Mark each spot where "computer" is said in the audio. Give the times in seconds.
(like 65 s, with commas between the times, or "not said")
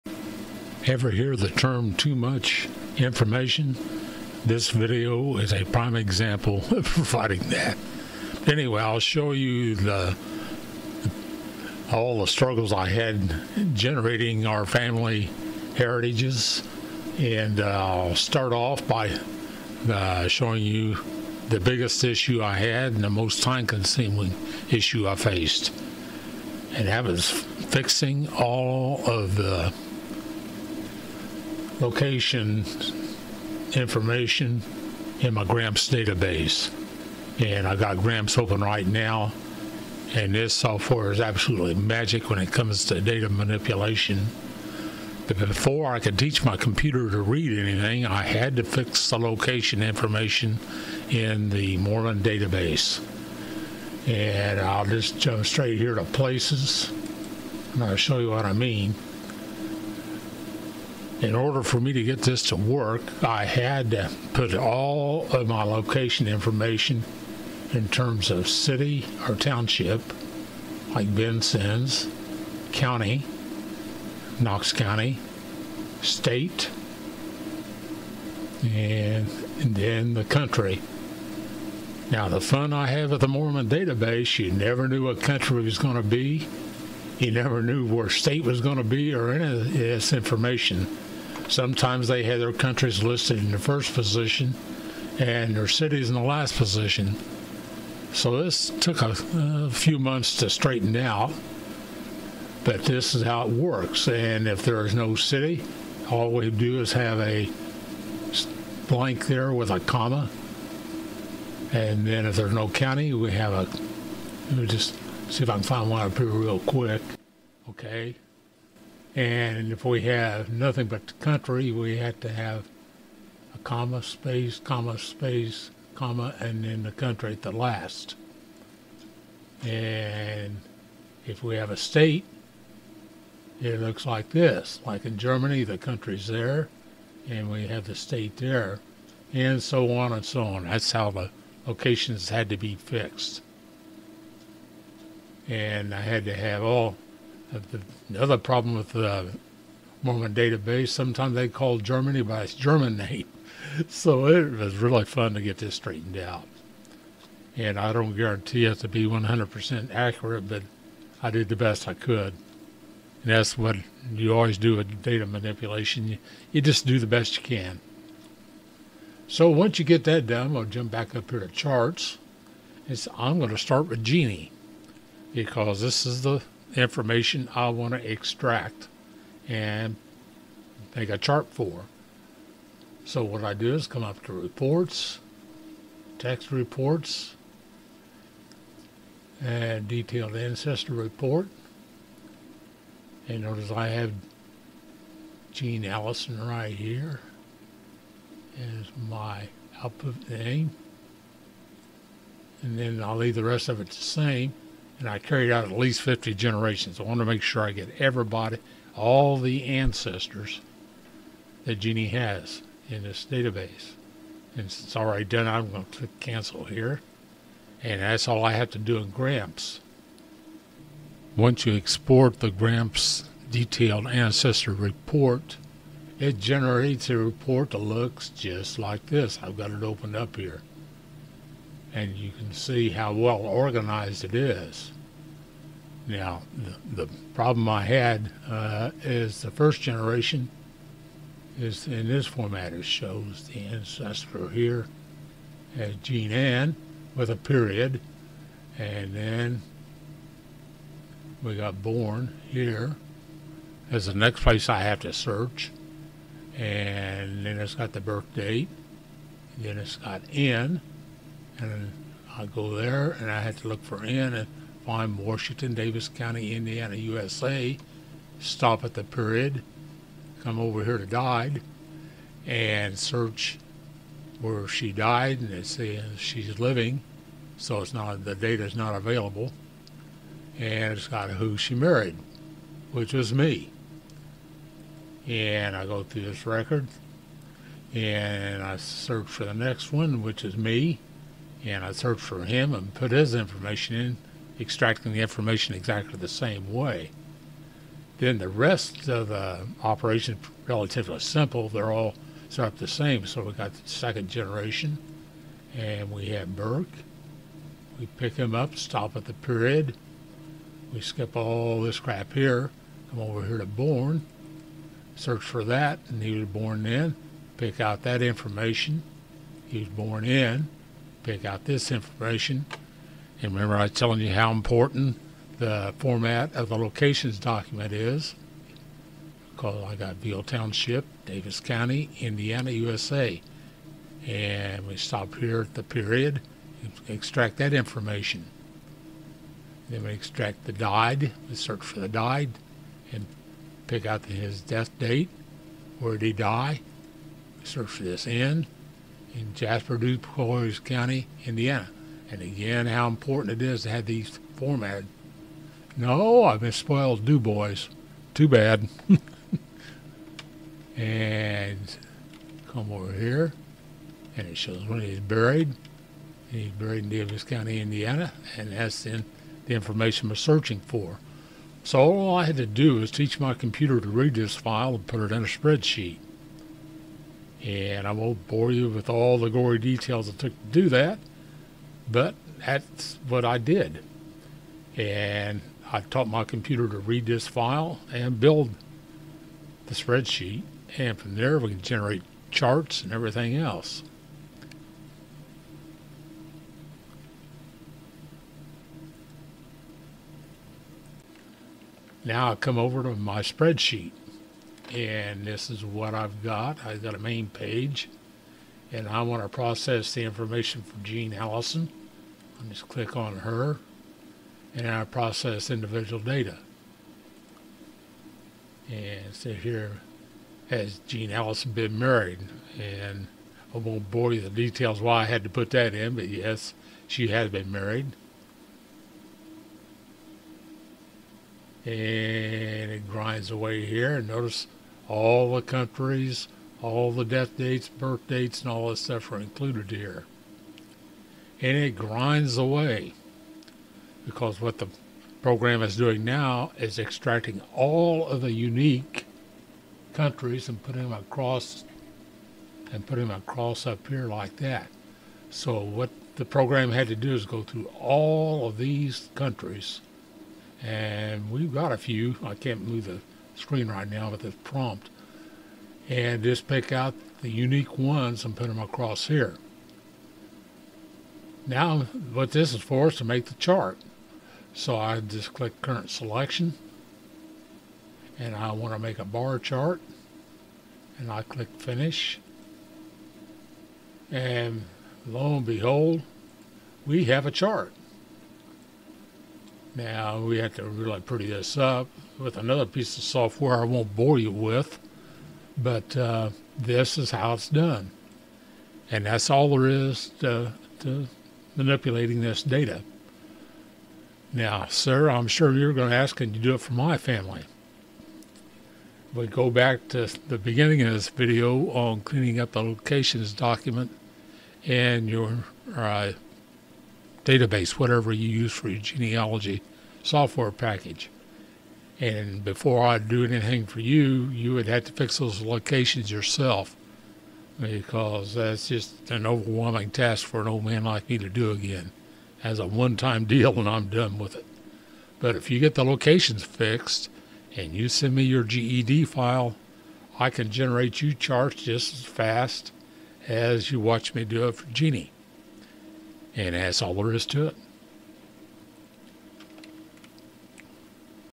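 46 s, 373 s, 386 s.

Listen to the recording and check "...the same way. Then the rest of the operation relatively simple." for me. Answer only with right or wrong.
right.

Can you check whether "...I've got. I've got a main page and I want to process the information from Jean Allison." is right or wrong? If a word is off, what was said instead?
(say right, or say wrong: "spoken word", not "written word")
right.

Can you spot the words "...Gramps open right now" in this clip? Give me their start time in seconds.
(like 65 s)
37 s.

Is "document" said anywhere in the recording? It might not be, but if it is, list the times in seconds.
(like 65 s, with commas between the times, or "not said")
327 s, 513 s.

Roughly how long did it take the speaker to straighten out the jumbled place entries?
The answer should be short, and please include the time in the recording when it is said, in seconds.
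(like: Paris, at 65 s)
a few months, at 99 s.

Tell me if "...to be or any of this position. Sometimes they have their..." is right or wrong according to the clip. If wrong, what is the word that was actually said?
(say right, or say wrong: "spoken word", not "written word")
wrong: "information", not "position".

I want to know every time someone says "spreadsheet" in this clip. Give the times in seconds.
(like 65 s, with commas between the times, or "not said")
375 s, 389 s, 403 s.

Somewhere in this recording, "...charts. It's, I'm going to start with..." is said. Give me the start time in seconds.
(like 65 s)
171 s.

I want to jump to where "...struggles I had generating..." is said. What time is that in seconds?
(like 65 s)
12 s.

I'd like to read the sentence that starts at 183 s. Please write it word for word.
So what I do is come up to reports, text reports, and detailed ancestor report.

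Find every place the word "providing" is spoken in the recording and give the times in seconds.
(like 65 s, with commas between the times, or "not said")
6 s.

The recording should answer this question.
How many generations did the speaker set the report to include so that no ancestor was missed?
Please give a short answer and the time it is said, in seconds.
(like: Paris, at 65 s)
50, at 206 s.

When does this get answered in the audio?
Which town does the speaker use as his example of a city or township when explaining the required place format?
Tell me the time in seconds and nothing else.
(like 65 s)
71 s.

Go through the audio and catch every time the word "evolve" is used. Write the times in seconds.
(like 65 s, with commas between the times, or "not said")
not said.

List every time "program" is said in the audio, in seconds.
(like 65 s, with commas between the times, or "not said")
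445 s, 456 s.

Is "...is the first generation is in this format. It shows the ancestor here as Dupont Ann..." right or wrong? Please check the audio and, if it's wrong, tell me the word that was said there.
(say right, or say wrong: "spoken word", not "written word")
wrong: "Jean", not "Dupont".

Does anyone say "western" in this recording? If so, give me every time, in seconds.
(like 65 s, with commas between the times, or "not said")
not said.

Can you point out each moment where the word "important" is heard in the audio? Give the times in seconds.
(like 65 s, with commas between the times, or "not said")
324 s, 353 s.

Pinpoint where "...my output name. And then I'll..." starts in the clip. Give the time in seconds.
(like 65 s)
199 s.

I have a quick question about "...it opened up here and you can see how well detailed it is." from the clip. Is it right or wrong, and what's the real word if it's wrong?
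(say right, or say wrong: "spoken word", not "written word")
wrong: "organized", not "detailed".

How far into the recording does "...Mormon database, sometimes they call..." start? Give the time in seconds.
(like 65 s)
150 s.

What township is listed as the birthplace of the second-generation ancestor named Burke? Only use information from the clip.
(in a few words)
Veale Township.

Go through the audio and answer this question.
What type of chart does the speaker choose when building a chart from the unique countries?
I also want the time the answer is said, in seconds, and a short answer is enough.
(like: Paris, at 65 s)
bar chart, at 479 s.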